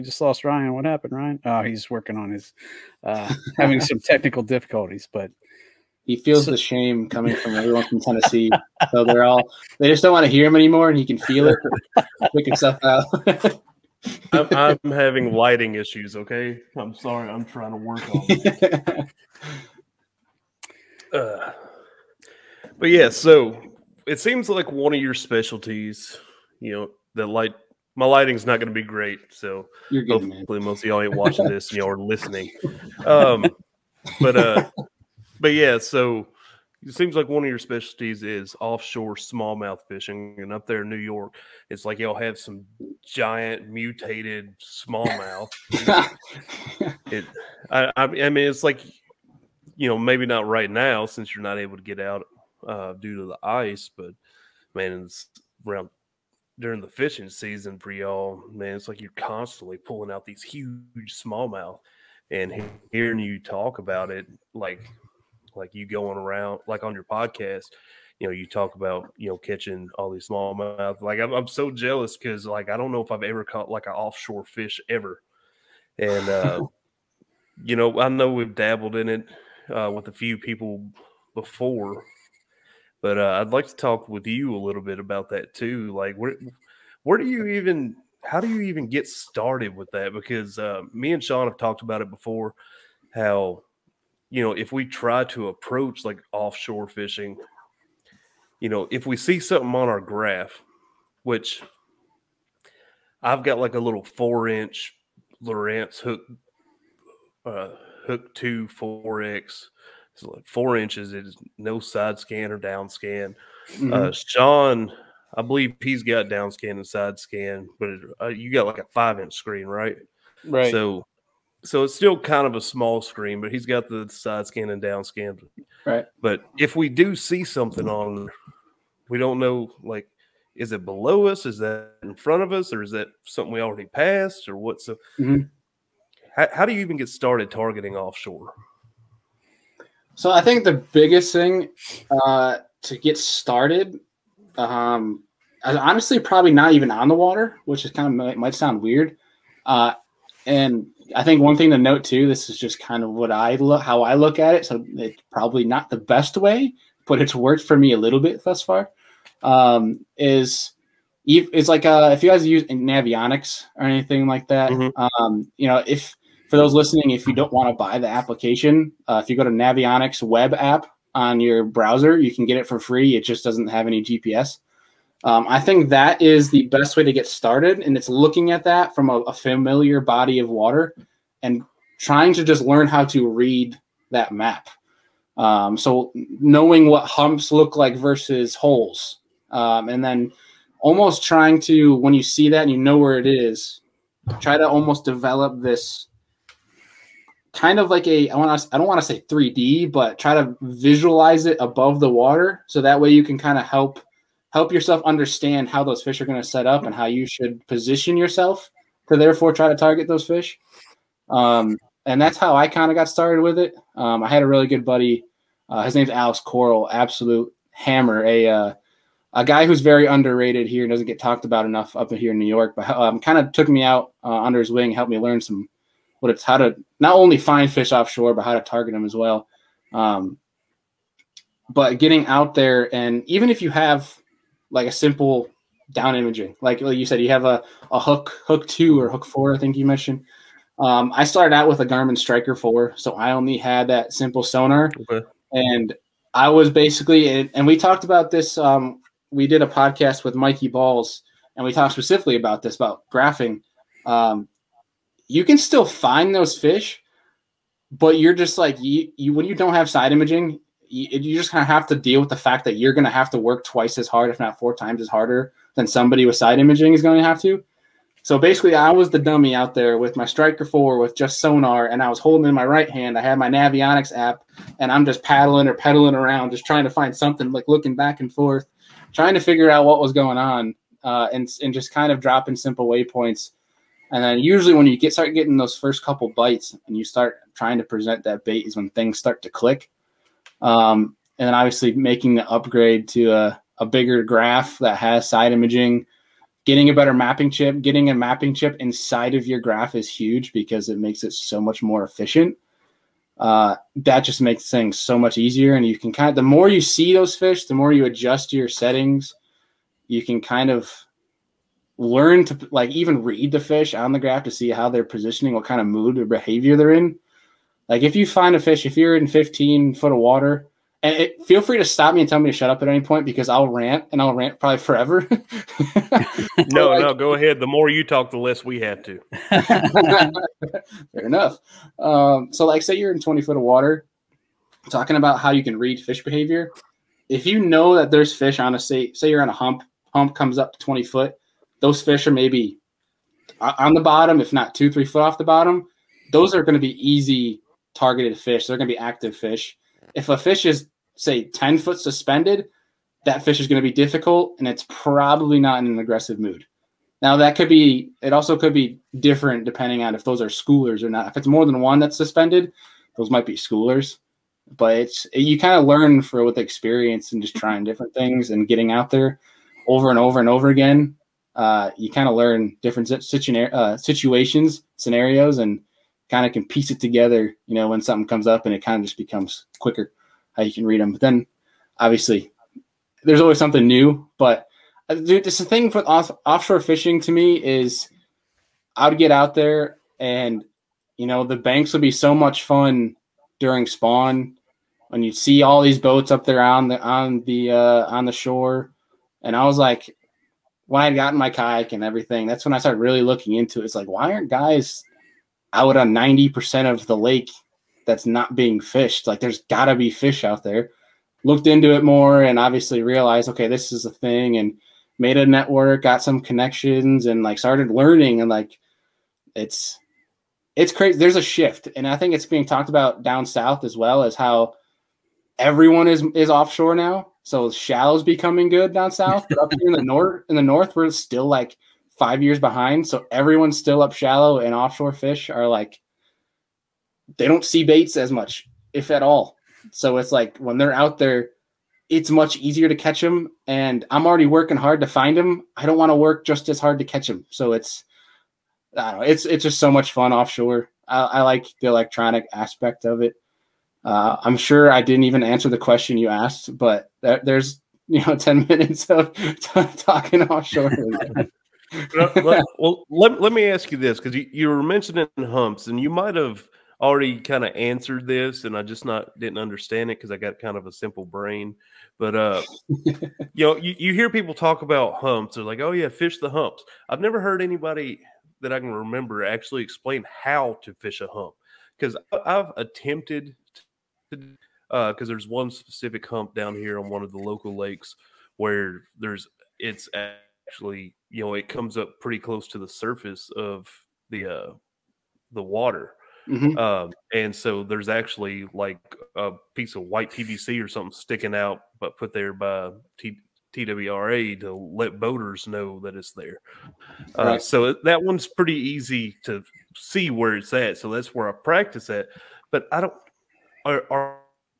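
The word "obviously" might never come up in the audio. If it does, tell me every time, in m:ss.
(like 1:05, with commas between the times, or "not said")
4:51, 6:21, 6:52.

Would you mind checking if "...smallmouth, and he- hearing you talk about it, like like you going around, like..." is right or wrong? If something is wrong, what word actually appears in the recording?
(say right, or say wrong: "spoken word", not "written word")
right.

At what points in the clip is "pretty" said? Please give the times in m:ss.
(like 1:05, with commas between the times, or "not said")
8:12, 8:28.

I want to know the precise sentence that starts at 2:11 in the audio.
Is that in front of us, or is that something we already passed, or what's so?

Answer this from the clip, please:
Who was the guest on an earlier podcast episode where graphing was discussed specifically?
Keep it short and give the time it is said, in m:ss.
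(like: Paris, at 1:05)
Mikey Balls, at 4:10.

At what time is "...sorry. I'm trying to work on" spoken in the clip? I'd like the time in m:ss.
0:16.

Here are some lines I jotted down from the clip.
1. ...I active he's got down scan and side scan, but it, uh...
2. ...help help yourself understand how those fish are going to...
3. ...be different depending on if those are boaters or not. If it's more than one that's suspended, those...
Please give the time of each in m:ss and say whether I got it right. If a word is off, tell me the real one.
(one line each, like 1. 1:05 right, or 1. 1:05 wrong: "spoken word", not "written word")
1. 1:55 wrong: "believe", not "active"
2. 3:23 right
3. 5:58 wrong: "schoolers", not "boaters".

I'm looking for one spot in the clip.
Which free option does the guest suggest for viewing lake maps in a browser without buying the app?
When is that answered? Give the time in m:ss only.
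2:49.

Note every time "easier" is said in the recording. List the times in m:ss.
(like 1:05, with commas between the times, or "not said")
5:05, 7:22.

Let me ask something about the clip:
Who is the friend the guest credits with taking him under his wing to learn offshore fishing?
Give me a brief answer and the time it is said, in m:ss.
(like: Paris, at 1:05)
Alex Coral, at 3:36.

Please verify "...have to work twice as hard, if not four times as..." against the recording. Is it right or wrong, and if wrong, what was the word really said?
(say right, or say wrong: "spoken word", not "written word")
right.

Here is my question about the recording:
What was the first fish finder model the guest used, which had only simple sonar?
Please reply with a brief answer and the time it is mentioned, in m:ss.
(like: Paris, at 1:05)
Garmin Striker 4, at 4:01.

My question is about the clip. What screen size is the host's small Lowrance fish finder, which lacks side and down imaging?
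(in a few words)
4 inch.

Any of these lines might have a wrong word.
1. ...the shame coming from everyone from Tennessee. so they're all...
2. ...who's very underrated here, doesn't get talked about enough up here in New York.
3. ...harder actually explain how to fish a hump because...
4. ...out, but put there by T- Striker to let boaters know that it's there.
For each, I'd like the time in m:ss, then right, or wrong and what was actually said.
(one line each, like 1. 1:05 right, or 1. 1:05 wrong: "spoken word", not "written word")
1. 0:06 right
2. 3:39 right
3. 7:58 wrong: "remember", not "harder"
4. 8:21 wrong: "TWRA", not "Striker".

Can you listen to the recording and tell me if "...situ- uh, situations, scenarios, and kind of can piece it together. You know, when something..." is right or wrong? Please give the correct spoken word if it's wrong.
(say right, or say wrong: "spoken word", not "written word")
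right.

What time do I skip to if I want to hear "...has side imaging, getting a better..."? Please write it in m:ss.
4:54.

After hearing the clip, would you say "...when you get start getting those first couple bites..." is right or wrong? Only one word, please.
right.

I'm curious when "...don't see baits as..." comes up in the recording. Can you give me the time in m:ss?
7:17.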